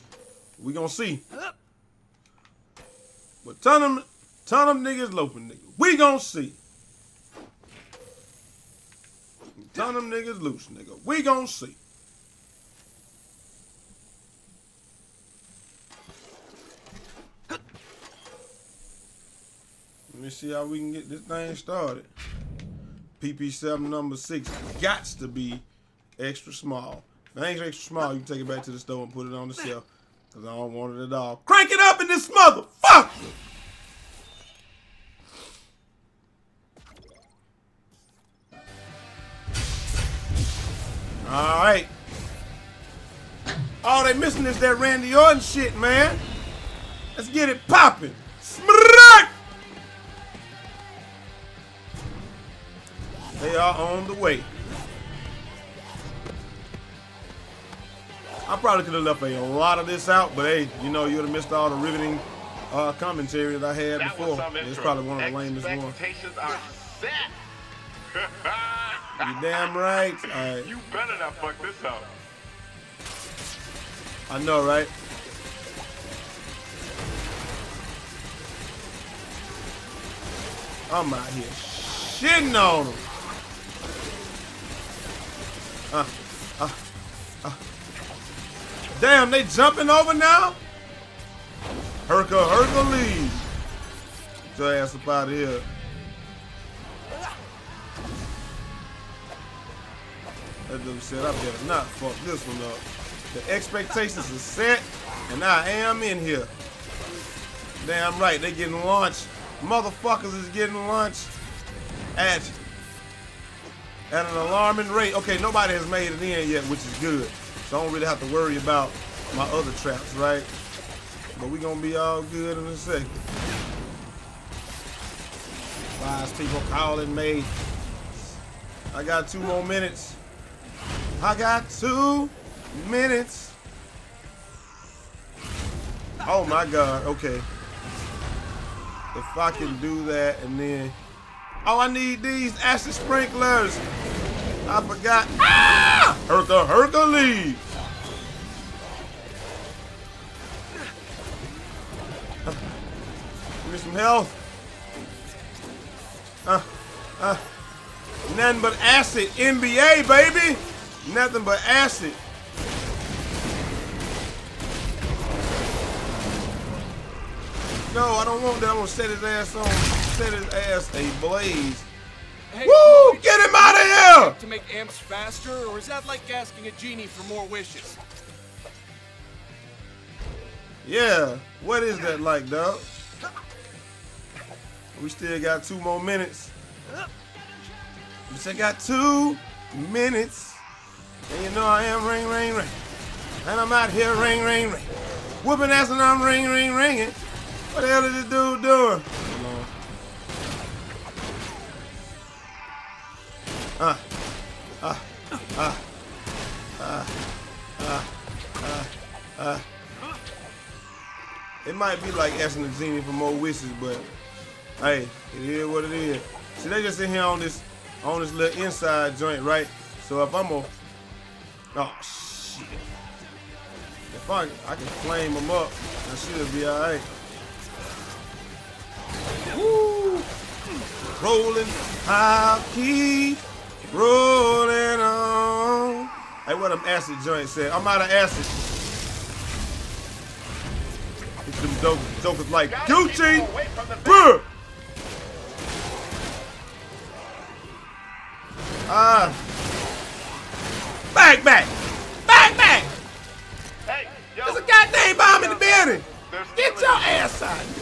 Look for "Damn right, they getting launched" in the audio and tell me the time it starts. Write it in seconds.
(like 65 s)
107 s.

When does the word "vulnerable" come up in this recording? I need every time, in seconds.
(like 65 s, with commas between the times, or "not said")
not said.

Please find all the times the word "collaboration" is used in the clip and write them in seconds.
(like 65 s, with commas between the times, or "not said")
not said.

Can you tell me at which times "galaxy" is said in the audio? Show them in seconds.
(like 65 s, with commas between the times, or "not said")
not said.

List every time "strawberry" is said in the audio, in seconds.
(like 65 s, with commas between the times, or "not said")
not said.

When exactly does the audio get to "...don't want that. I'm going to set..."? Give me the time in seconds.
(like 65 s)
168 s.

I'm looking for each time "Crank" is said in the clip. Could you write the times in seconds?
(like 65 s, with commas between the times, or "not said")
31 s.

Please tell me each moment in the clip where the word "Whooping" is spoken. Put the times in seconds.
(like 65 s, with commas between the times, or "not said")
195 s.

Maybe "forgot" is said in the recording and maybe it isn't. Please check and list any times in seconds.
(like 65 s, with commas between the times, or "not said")
144 s.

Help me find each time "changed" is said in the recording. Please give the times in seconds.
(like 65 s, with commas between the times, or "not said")
not said.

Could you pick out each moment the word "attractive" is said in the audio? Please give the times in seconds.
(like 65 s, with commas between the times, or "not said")
not said.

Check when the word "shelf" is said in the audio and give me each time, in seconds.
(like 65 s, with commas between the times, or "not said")
29 s.